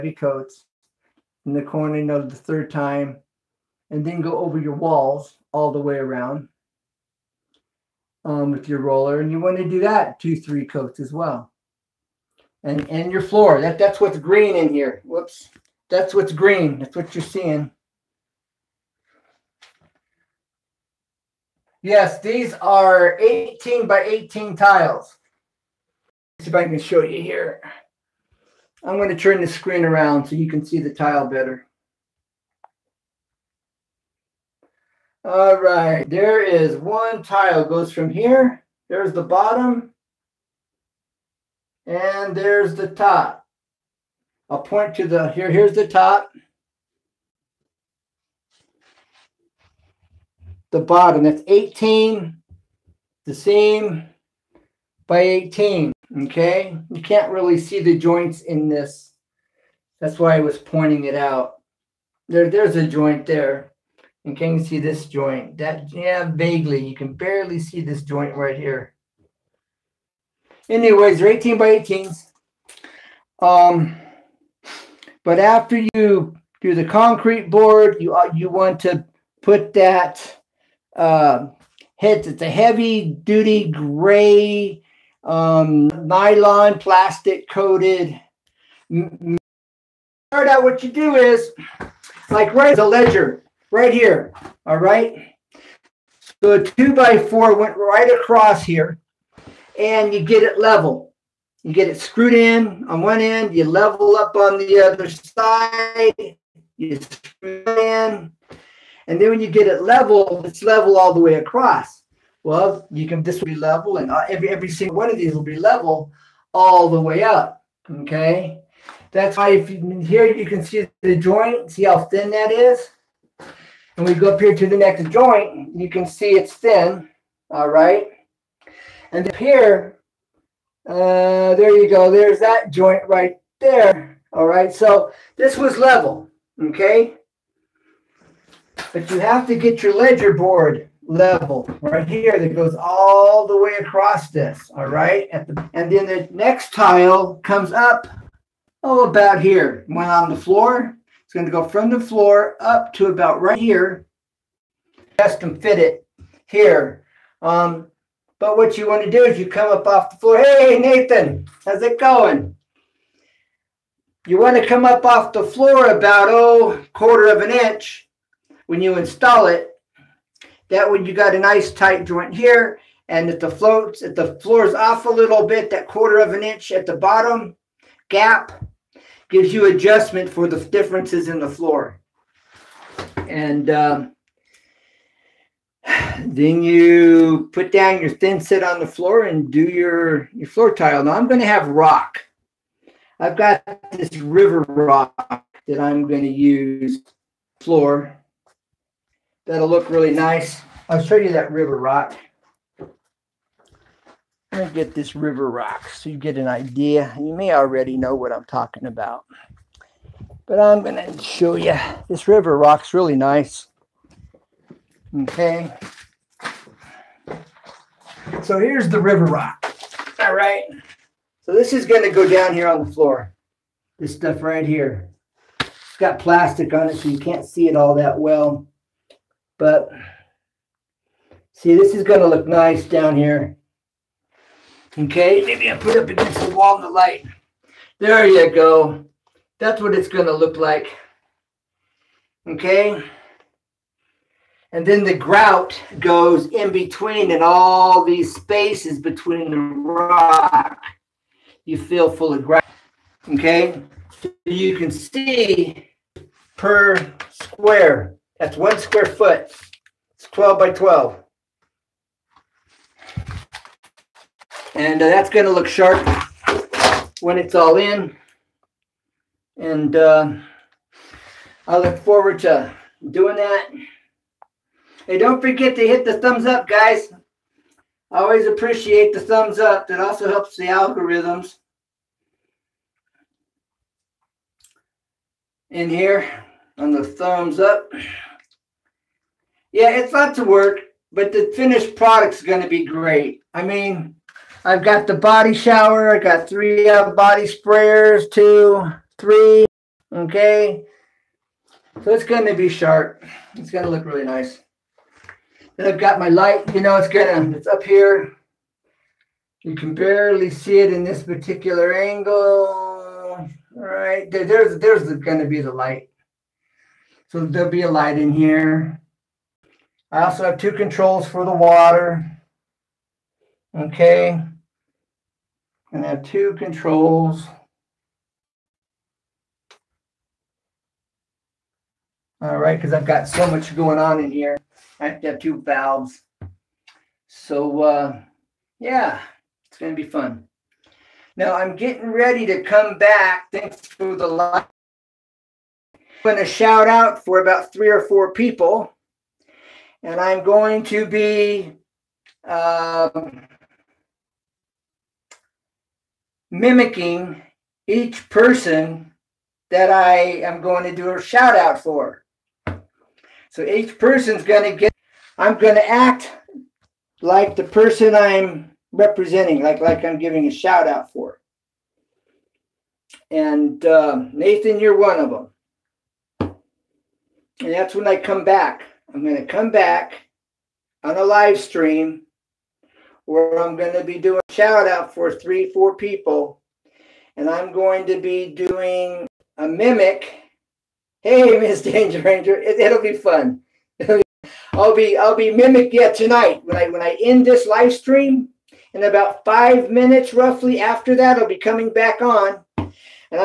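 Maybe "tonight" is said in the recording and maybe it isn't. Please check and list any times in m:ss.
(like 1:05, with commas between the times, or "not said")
6:36.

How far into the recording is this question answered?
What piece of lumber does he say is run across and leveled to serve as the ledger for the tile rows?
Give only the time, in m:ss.
1:36.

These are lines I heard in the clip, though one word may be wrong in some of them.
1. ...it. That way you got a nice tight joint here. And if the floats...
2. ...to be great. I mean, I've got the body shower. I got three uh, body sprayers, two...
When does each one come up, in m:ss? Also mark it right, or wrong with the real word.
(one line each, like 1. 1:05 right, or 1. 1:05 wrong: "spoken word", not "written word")
1. 2:49 right
2. 4:52 right.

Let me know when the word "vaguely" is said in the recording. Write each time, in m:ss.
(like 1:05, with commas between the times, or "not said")
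1:06.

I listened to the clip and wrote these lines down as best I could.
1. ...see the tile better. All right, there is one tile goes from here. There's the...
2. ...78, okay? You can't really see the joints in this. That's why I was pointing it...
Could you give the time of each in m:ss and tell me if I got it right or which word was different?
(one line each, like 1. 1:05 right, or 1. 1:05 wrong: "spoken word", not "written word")
1. 0:30 right
2. 0:55 wrong: "18", not "78".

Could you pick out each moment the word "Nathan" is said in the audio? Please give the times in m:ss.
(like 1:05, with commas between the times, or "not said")
2:40, 6:14.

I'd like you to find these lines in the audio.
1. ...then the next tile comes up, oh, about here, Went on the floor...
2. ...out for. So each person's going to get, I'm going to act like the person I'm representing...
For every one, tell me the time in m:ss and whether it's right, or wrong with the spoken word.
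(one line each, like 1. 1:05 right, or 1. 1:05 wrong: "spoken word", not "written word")
1. 2:25 right
2. 6:01 right.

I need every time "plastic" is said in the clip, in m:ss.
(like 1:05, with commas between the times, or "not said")
1:26, 3:46.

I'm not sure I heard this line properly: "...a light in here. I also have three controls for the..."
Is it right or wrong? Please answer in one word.
wrong.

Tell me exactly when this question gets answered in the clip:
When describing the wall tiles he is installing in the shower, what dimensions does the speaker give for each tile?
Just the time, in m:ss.
0:23.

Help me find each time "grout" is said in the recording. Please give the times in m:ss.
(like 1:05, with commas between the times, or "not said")
4:05, 4:12.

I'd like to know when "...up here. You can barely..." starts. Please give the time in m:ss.
5:07.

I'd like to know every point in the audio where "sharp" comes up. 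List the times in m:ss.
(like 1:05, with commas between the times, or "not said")
4:25, 5:02.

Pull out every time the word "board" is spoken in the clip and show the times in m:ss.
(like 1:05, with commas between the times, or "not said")
1:17, 2:20.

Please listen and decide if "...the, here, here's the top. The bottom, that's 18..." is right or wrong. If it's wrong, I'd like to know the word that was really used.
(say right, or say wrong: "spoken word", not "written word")
right.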